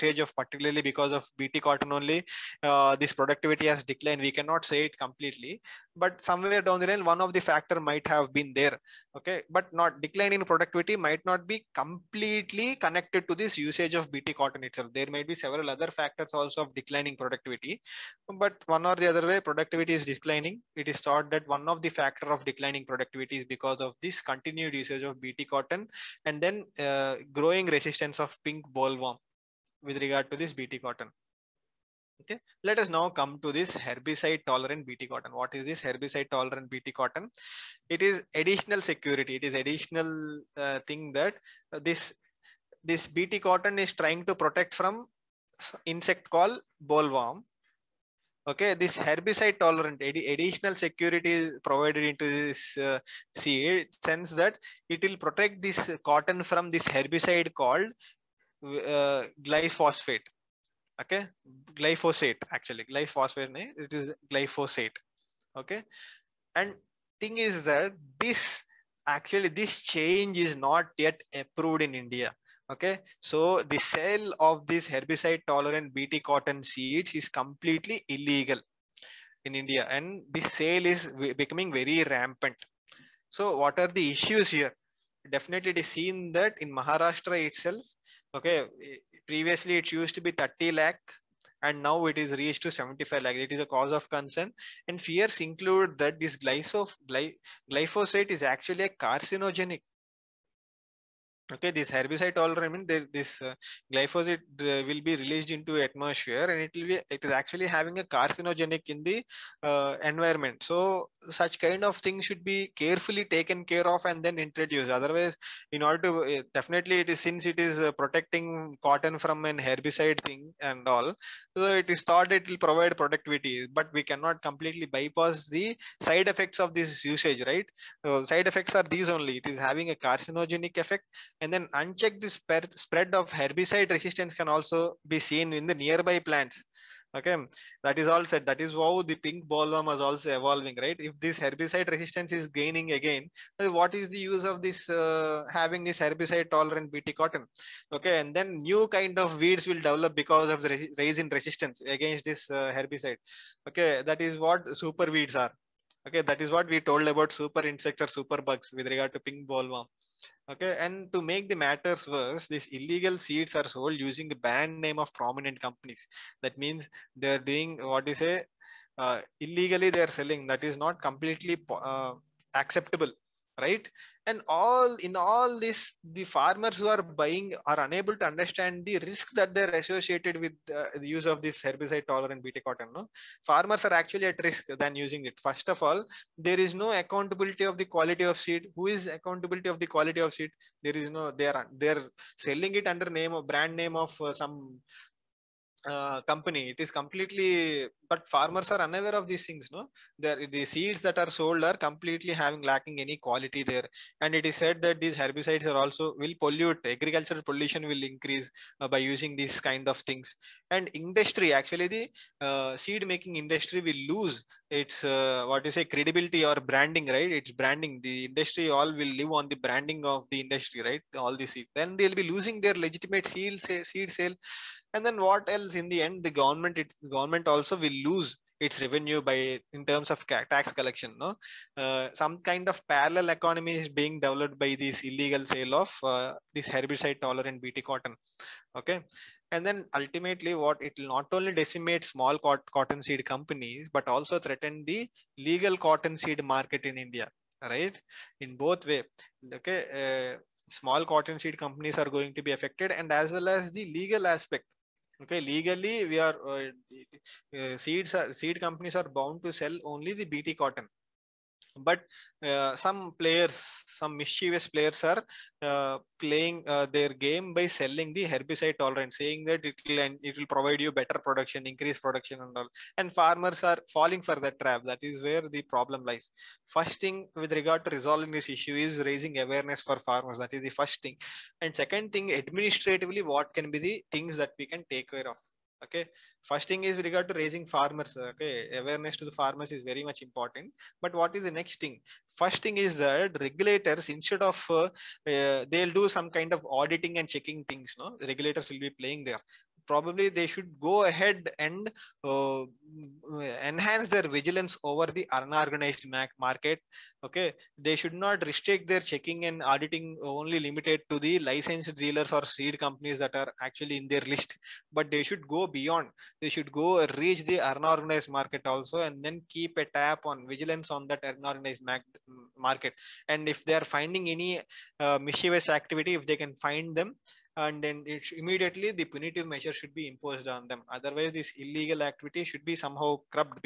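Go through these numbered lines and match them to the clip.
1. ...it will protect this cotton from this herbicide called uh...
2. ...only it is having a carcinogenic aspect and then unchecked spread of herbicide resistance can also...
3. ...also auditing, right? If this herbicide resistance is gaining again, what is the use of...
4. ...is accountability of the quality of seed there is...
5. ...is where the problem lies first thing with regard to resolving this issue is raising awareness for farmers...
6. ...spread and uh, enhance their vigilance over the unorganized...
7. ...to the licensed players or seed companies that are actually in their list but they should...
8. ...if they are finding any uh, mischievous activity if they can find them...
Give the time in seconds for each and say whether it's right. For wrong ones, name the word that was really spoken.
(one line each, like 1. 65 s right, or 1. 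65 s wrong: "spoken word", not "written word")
1. 54 s right
2. 129 s wrong: "effect", not "aspect"
3. 140 s wrong: "evolving", not "auditing"
4. 188 s right
5. 275 s right
6. 301 s wrong: "ahead", not "spread"
7. 311 s wrong: "dealers", not "players"
8. 323 s right.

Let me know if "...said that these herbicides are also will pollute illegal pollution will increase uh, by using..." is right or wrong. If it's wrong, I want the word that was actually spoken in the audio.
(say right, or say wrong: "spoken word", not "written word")
wrong: "agricultural", not "illegal".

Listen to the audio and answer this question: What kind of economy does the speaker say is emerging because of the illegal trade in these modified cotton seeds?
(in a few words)
Parallel economy.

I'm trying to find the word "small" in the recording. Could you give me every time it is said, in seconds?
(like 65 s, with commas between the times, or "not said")
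242 s, 250 s.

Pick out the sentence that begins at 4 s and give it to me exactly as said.
We cannot say it completely, but somewhere down the line, one of the factor might have been there.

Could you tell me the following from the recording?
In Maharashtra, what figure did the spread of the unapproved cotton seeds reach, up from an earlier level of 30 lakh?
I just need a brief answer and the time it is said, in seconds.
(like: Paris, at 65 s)
75 lakh, at 92 s.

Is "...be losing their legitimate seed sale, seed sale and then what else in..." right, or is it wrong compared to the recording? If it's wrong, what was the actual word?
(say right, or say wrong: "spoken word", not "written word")
right.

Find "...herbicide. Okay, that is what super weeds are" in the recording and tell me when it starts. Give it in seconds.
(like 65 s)
152 s.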